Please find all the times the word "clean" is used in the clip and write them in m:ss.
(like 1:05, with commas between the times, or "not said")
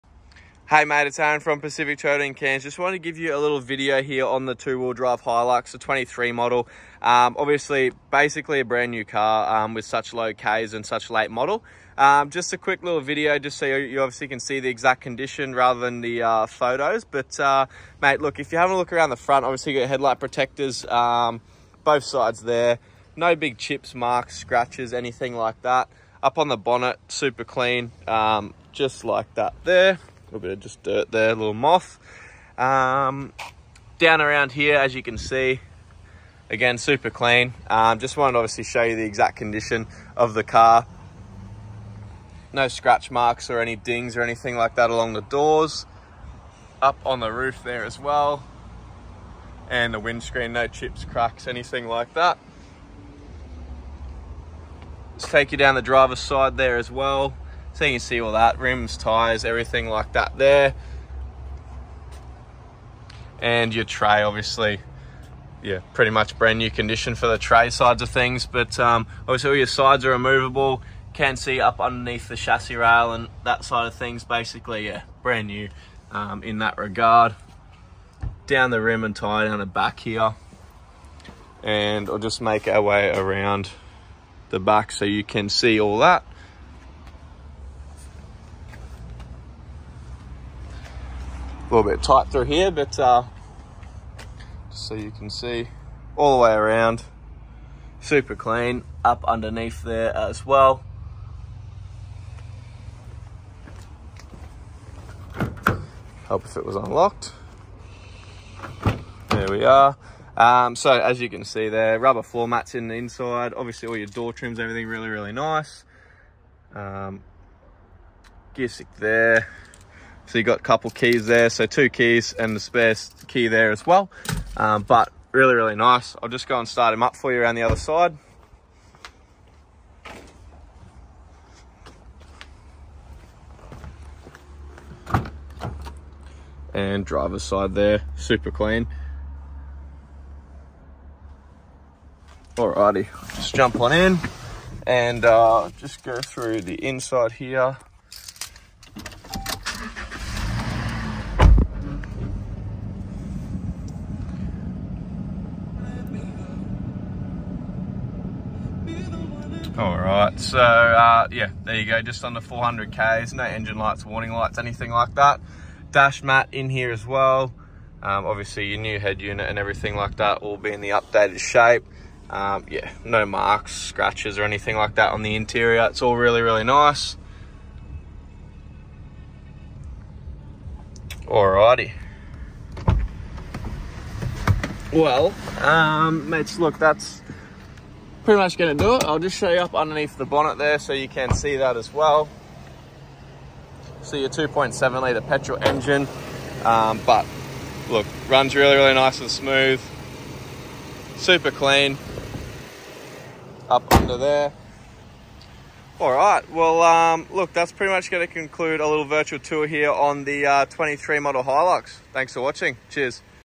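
0:27, 0:37, 1:38, 2:18, 3:21.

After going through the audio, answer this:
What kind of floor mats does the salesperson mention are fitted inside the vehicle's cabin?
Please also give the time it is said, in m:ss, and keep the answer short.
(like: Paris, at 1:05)
Rubber floor mats, at 1:51.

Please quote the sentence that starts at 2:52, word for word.
Um, yeah, no marks, scratches or anything like that on the interior.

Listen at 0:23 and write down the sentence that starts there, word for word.
No big chips, marks, scratches, anything like that.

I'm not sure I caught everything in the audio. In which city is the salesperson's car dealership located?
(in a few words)
Cairns.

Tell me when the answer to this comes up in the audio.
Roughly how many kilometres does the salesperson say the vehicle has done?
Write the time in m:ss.
2:42.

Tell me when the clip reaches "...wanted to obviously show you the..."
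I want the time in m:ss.
0:38.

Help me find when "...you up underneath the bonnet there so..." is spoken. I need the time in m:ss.
3:09.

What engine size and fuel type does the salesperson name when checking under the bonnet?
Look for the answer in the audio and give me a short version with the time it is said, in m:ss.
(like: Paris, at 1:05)
2.7 litre petrol, at 3:14.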